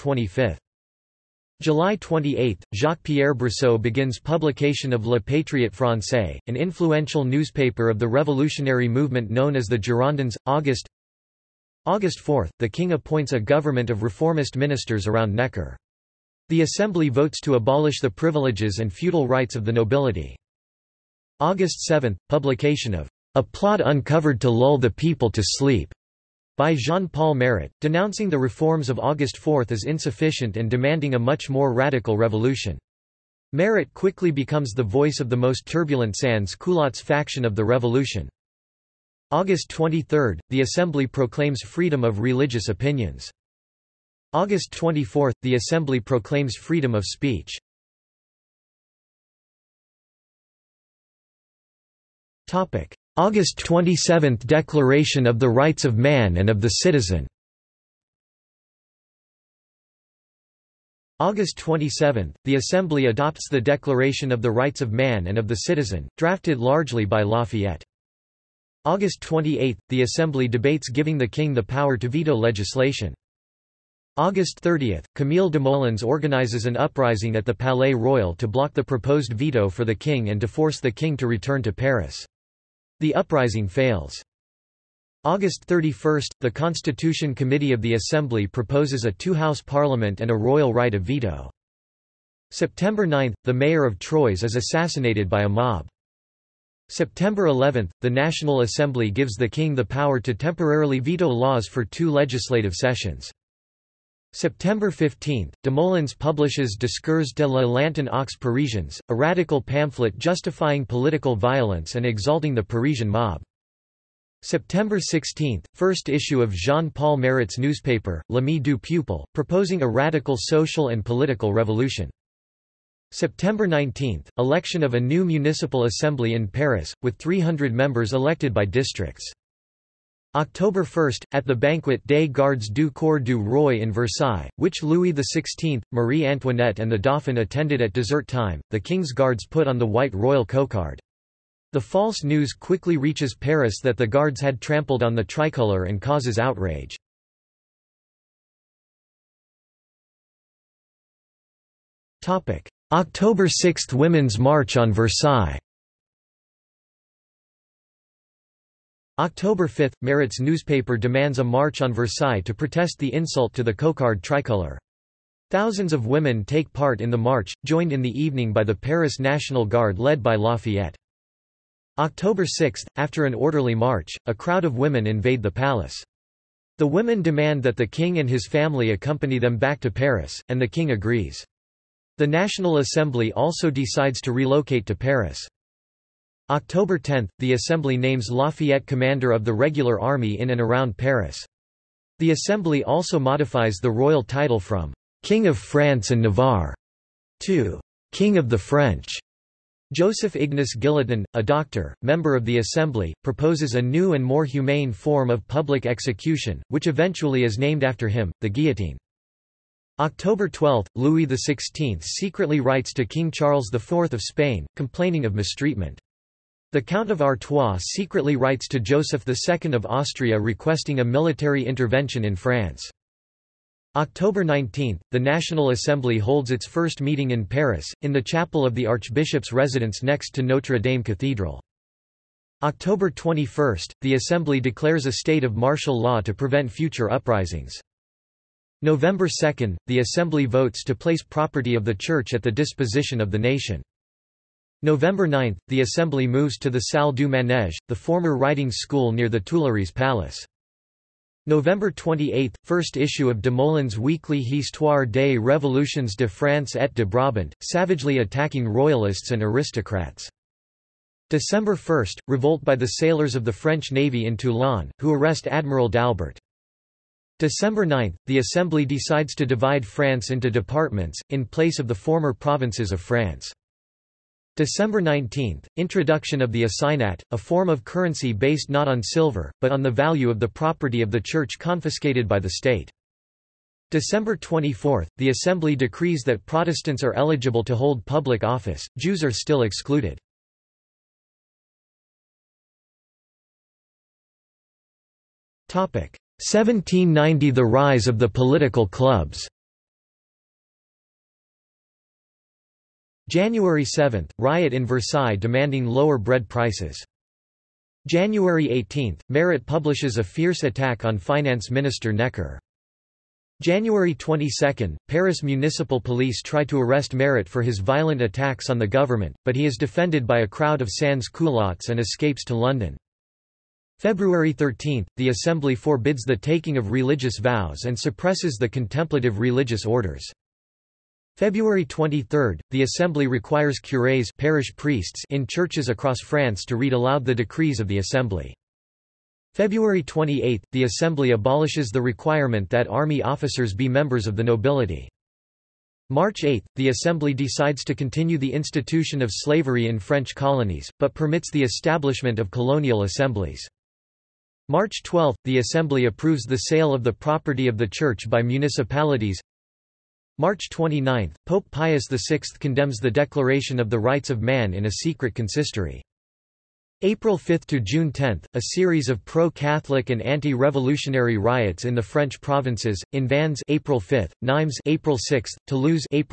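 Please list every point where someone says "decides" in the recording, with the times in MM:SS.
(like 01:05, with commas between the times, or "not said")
03:03, 04:28, 05:47.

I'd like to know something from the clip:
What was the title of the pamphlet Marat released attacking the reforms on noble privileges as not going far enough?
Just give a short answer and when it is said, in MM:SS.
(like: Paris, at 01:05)
A Plot Uncovered to Lull the People to Sleep, at 00:23.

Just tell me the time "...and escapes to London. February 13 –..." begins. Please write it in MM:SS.
05:21.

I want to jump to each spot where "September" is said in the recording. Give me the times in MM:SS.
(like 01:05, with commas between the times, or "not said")
01:32, 01:36, 01:44, 01:54, 02:03.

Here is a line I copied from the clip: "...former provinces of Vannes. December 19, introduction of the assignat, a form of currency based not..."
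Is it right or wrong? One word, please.
wrong.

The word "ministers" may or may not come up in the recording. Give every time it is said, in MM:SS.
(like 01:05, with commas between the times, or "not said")
00:14, 05:11.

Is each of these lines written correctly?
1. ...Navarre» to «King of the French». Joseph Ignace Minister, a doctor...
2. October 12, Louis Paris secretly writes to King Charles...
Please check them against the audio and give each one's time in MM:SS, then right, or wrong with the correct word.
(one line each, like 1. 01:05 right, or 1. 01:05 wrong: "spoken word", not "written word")
1. 03:16 wrong: "Guillotin", not "Minister"
2. 03:30 wrong: "XVI", not "Paris".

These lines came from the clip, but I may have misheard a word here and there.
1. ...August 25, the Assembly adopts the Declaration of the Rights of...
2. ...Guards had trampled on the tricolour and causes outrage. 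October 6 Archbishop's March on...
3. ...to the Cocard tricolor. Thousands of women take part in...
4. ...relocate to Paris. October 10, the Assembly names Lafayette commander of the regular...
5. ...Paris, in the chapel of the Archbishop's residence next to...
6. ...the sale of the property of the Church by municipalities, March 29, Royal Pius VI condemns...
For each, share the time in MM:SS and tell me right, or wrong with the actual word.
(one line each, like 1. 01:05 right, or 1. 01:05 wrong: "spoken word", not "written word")
1. 01:01 wrong: "27", not "25"
2. 02:24 wrong: "Women", not "Archbishop"
3. 02:43 right
4. 03:04 right
5. 03:47 right
6. 05:56 wrong: "Pope", not "Royal".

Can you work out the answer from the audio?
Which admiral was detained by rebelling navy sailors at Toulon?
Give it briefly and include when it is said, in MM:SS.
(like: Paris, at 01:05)
Admiral d'Albert, at 04:25.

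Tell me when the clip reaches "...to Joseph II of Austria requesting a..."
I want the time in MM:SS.
03:38.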